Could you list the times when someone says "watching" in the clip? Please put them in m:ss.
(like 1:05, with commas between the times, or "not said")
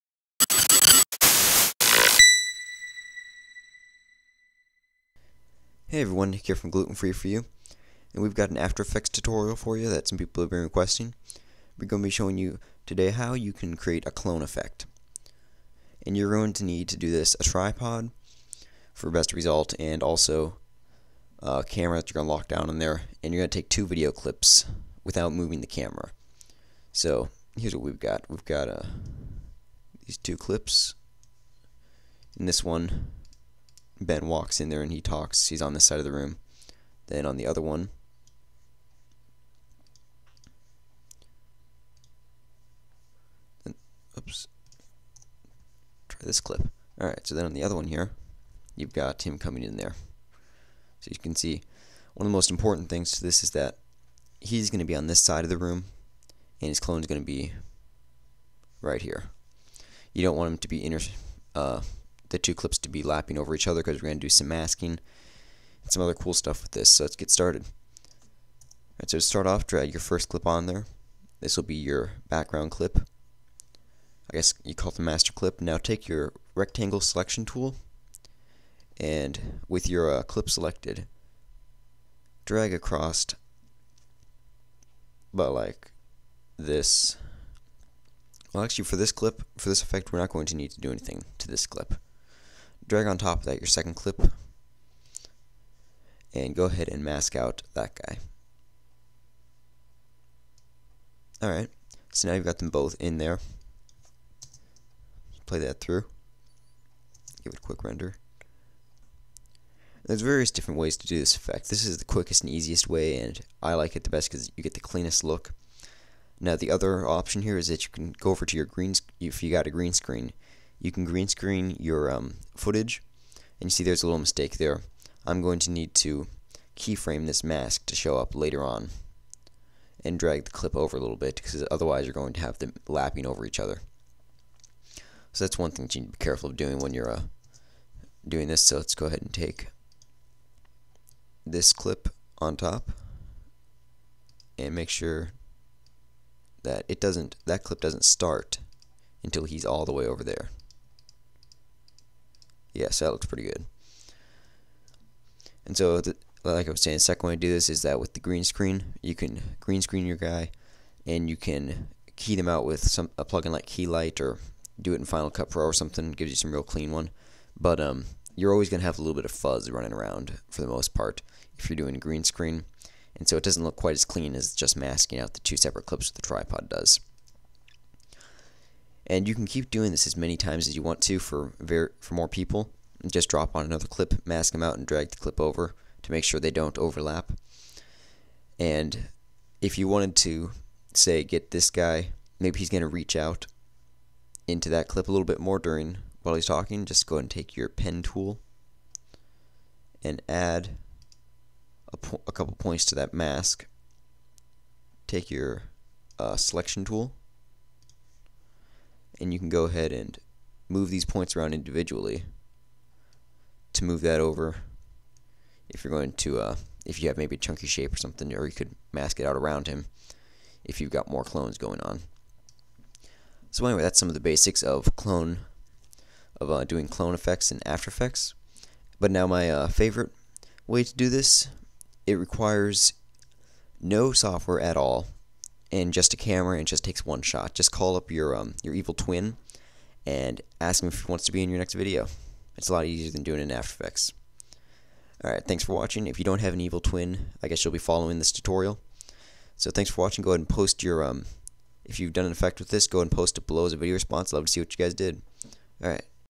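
4:05, 4:10.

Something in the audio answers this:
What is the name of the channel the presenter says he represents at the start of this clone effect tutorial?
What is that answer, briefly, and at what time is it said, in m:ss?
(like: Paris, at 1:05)
Gluten Free For You, at 0:06.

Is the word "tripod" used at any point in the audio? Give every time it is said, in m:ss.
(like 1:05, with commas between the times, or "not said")
0:17, 2:56.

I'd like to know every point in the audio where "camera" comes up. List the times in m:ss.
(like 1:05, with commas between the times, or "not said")
0:21, 0:25, 3:56.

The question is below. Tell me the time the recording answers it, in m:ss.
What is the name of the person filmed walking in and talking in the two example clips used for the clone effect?
0:34.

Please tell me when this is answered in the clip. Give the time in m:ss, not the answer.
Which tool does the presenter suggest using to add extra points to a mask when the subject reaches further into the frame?
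3:17.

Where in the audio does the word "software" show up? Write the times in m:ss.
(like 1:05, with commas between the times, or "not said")
3:54.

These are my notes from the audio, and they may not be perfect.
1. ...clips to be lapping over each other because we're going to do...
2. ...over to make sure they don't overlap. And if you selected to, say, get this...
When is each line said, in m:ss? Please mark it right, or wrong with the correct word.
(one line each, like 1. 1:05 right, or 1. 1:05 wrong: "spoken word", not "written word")
1. 1:02 right
2. 3:05 wrong: "wanted", not "selected".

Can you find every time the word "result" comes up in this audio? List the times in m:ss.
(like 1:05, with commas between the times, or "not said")
0:19.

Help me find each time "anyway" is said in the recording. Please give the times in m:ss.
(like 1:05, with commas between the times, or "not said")
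3:43.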